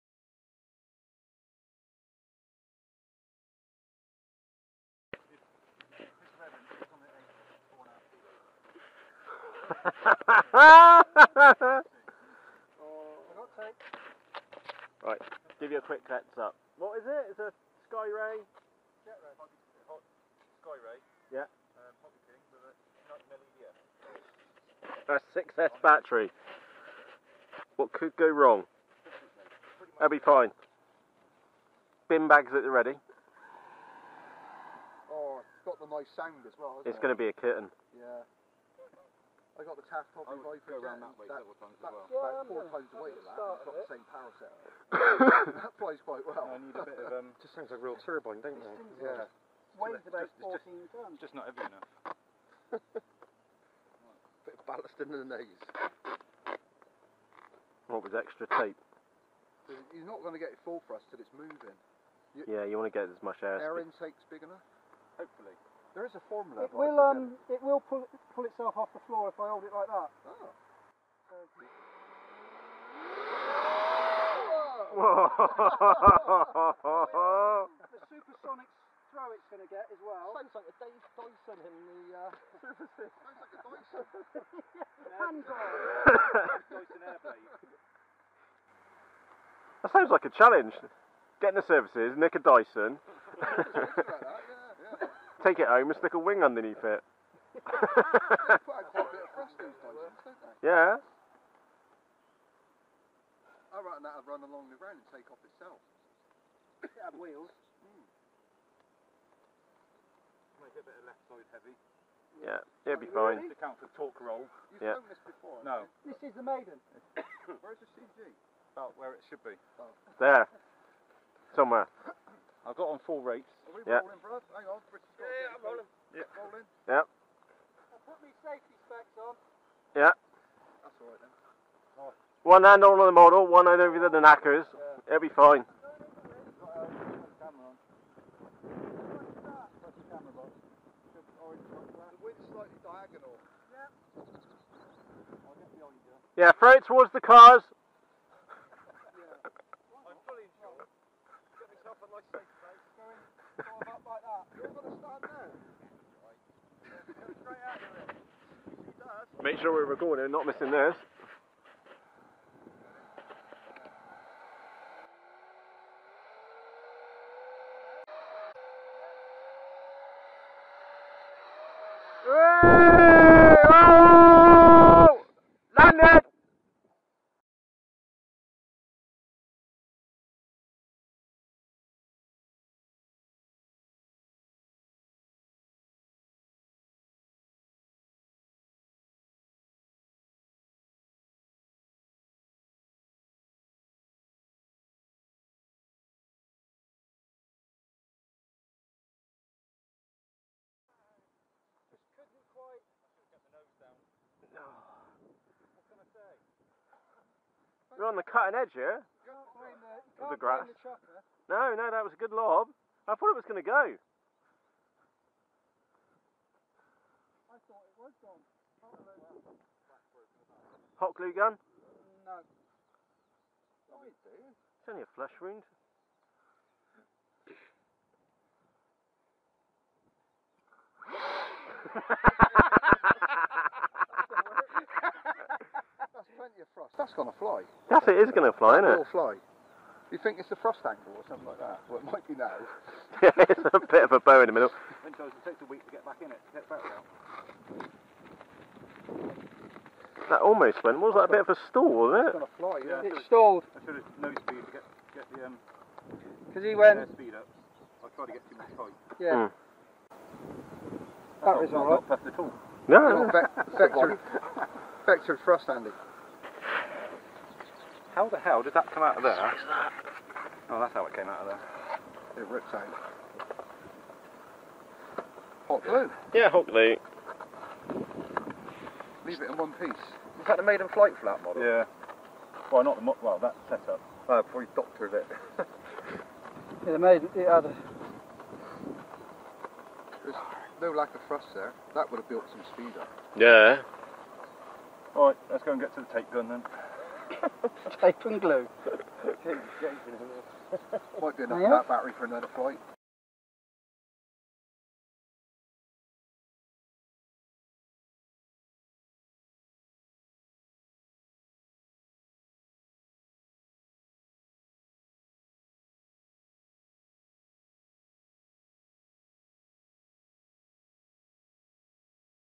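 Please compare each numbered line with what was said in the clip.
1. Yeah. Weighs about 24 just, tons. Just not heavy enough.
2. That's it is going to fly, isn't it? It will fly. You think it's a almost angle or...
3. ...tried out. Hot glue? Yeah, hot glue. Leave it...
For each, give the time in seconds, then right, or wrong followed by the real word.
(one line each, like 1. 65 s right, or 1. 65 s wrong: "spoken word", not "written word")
1. 49 s wrong: "14", not "24"
2. 237 s wrong: "thrust", not "almost"
3. 272 s wrong: "ripped", not "tried".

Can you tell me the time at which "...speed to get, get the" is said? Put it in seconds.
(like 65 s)
254 s.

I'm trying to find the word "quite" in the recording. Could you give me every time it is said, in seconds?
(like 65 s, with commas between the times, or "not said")
46 s.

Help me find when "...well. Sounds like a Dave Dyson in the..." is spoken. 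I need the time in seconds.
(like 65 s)
80 s.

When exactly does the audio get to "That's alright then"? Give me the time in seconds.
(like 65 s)
130 s.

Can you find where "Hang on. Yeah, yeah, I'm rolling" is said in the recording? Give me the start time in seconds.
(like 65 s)
124 s.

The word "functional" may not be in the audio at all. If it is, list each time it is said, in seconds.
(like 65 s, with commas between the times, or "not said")
not said.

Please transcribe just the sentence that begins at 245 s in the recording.
It takes a week to get back in it, get back That almost went.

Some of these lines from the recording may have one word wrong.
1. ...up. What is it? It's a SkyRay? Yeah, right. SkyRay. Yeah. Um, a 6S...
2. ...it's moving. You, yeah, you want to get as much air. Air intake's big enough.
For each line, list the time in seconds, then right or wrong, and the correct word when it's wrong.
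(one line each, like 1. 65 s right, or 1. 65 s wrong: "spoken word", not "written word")
1. 16 s right
2. 61 s right.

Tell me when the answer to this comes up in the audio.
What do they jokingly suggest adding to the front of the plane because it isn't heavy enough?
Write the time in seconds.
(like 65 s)
54 s.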